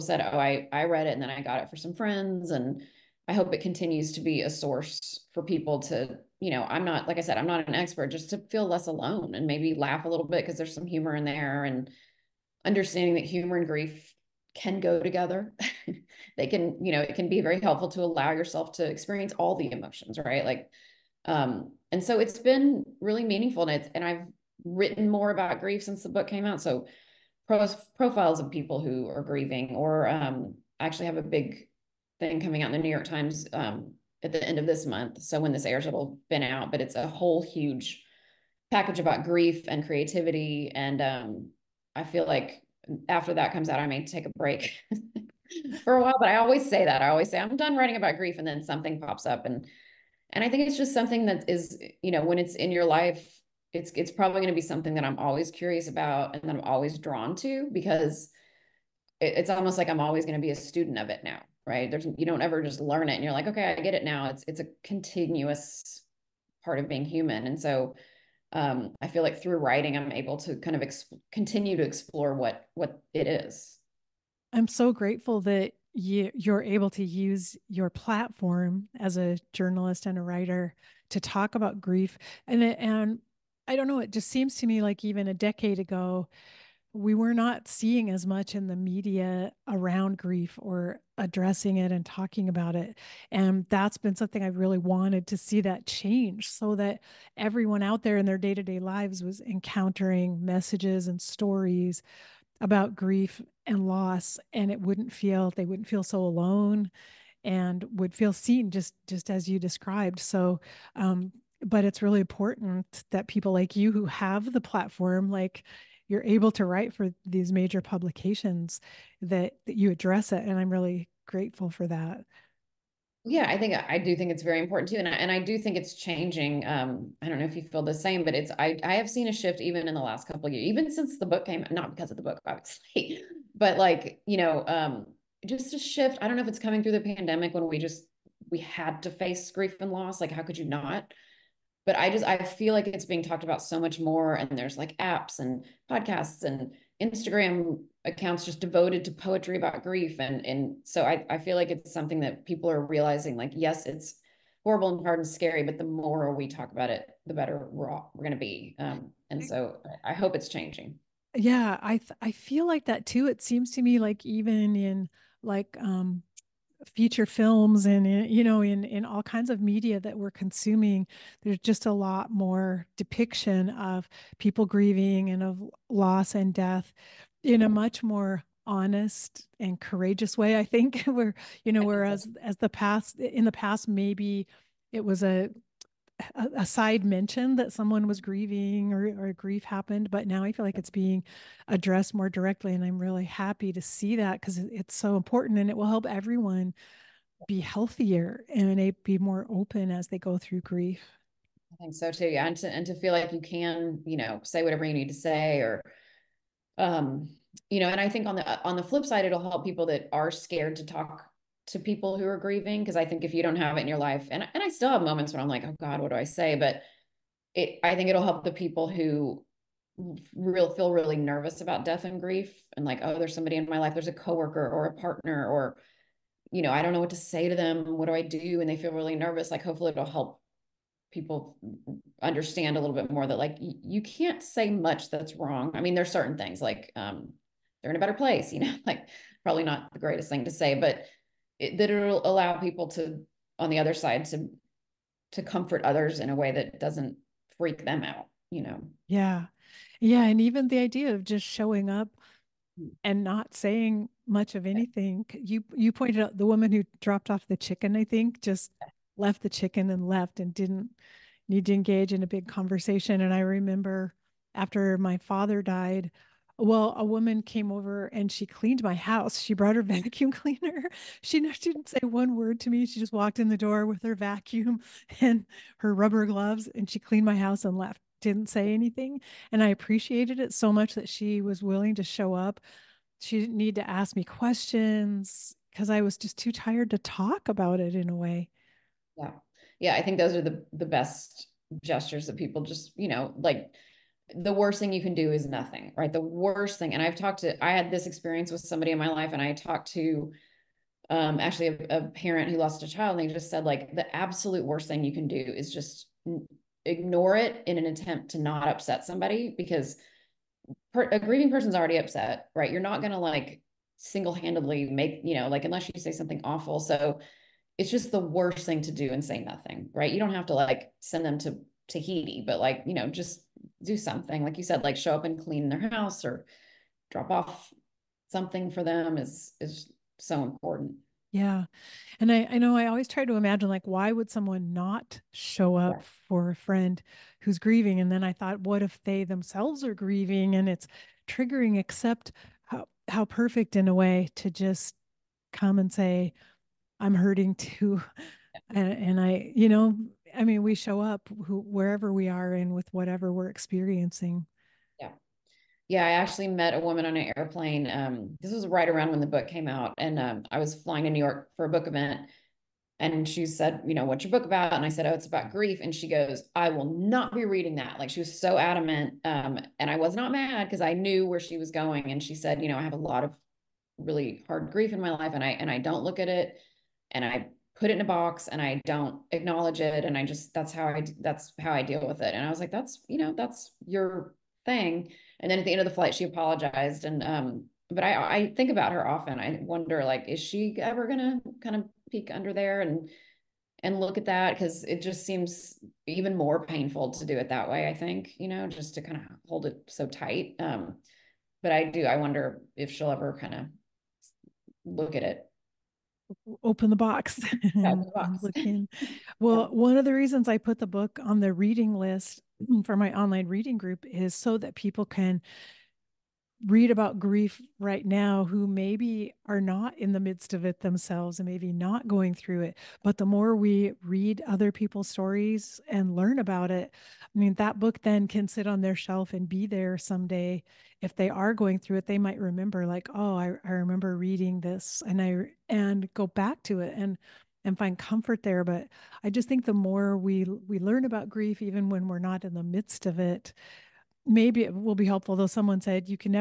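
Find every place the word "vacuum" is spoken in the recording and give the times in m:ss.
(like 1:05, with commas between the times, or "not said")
4:29, 4:34.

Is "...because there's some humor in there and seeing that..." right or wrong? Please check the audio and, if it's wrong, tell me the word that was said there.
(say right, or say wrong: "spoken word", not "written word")
wrong: "understanding", not "seeing".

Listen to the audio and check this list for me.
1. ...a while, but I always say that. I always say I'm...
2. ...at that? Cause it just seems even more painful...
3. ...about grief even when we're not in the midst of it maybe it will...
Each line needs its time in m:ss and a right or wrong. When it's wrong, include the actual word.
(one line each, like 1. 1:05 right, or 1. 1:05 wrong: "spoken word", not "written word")
1. 0:45 right
2. 6:34 right
3. 7:21 right.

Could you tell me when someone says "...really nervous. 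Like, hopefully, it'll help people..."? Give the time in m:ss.
3:48.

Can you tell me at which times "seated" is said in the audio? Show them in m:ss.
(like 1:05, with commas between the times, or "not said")
not said.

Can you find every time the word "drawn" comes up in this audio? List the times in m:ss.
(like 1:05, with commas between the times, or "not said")
0:56.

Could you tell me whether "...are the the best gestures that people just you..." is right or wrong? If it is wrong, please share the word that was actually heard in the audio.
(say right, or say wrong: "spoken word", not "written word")
right.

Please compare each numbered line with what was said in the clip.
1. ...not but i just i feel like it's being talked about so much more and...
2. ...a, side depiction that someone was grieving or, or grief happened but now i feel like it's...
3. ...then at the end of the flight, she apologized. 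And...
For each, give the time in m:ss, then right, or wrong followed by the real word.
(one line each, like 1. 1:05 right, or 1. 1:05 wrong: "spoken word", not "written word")
1. 2:20 right
2. 3:06 wrong: "mention", not "depiction"
3. 6:25 right.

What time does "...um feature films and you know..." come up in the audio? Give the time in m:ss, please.
2:45.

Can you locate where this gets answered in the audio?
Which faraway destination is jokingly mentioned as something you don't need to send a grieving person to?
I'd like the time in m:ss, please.
5:21.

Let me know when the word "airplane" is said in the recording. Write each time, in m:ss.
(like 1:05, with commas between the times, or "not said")
5:57.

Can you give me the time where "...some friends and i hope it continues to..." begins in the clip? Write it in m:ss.
0:01.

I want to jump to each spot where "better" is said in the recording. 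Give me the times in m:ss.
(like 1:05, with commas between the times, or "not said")
2:37, 3:57.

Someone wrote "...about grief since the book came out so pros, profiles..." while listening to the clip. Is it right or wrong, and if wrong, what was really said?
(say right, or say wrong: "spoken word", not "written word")
right.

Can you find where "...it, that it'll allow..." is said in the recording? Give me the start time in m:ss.
4:01.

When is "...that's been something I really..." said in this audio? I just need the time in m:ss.
1:33.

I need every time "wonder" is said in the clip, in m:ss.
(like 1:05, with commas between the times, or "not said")
6:29, 6:42.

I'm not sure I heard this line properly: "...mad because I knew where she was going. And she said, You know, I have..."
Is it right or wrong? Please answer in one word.
right.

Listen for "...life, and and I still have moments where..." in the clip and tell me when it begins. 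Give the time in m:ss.
3:33.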